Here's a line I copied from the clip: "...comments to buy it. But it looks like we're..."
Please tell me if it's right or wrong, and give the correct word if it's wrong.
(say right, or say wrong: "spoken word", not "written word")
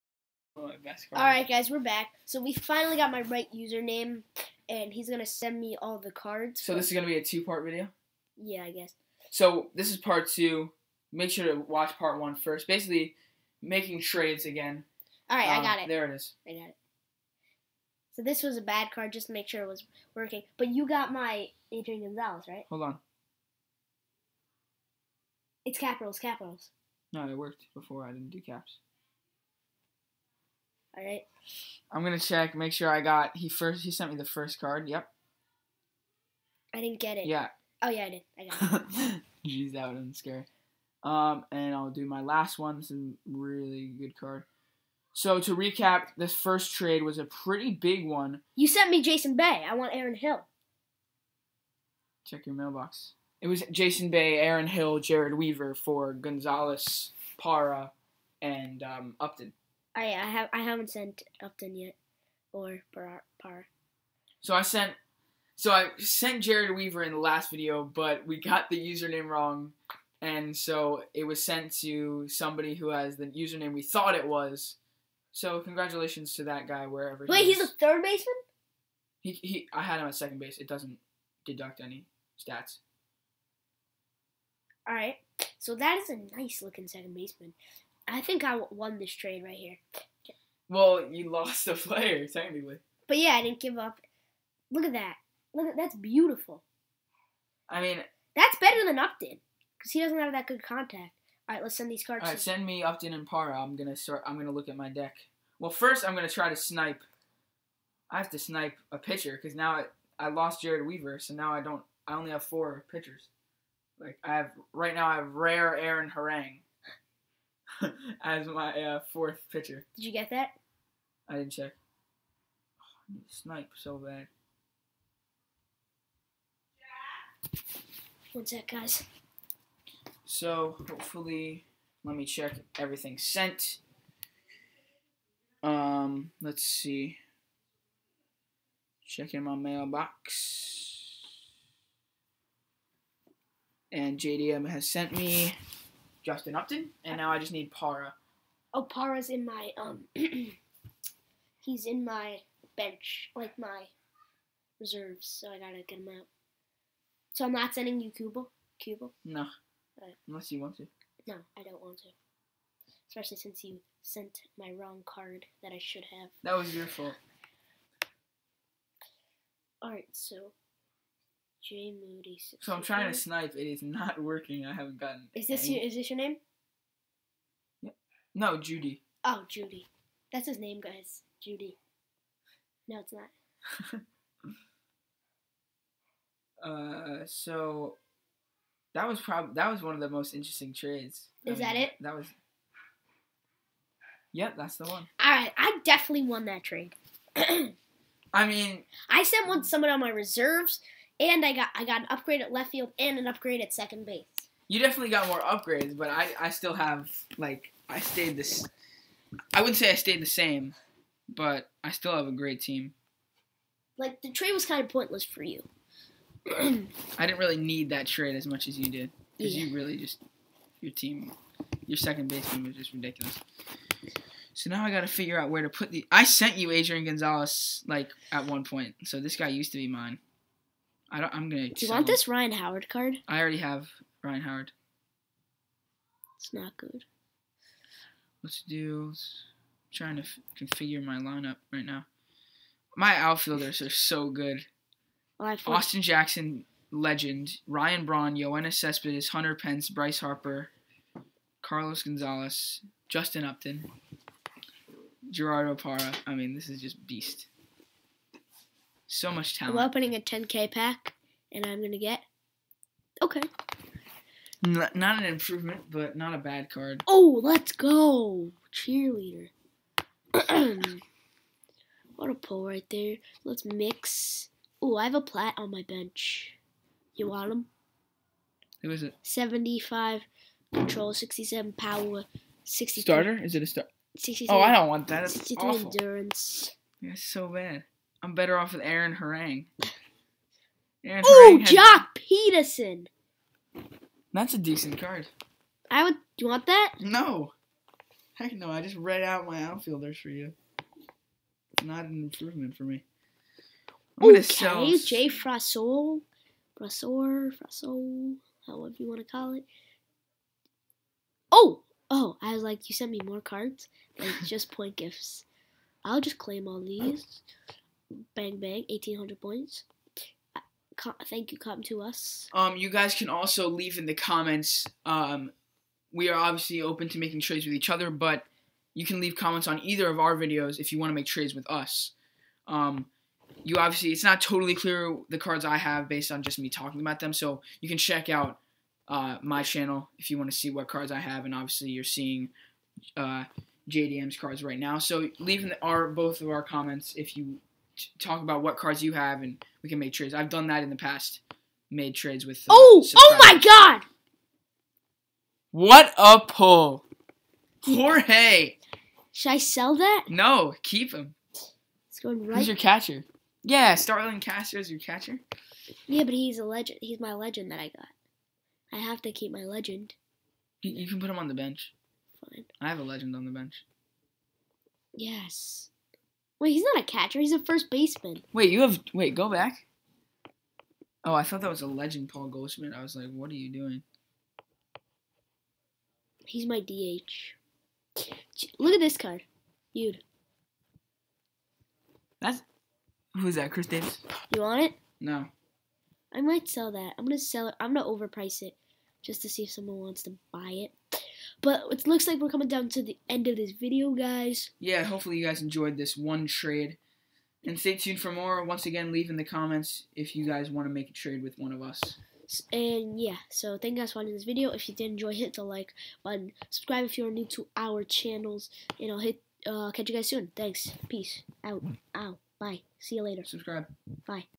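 wrong: "wants", not "comments".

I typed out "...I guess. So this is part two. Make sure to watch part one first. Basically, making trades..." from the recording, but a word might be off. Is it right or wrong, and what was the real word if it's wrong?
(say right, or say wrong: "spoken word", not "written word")
right.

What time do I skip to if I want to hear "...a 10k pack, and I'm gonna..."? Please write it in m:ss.
4:20.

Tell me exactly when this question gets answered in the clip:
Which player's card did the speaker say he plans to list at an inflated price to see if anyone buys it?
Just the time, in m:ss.
6:33.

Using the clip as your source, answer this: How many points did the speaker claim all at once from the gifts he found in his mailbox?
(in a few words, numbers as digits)
1800.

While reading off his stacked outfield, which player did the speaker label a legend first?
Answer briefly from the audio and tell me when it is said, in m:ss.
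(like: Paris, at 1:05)
Austin Jackson, at 4:05.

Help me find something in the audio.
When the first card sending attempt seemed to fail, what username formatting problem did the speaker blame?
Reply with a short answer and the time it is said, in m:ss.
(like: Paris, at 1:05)
Capitals, at 0:25.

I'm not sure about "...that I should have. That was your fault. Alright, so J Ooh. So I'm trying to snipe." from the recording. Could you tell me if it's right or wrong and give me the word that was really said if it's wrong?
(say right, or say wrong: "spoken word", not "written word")
wrong: "Moody", not "Ooh".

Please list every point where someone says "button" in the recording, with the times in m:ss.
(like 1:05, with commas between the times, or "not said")
6:56.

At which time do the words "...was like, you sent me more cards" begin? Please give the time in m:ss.
5:12.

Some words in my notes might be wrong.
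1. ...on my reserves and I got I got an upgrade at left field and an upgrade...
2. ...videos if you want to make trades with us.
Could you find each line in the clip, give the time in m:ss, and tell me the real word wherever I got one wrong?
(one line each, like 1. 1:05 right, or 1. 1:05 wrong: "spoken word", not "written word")
1. 3:19 right
2. 5:30 right.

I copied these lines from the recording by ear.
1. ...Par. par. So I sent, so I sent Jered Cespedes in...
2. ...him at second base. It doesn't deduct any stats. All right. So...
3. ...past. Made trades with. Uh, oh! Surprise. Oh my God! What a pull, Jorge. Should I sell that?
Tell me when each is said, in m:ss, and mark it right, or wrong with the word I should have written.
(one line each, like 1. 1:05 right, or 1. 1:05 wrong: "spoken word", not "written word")
1. 1:02 wrong: "Weaver", not "Cespedes"
2. 1:19 right
3. 5:50 right.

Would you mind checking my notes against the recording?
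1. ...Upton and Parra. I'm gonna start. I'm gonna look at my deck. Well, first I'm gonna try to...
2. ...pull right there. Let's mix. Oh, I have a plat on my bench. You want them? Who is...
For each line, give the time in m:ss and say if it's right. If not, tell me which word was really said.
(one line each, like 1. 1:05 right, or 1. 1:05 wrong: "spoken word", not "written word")
1. 1:42 right
2. 4:32 right.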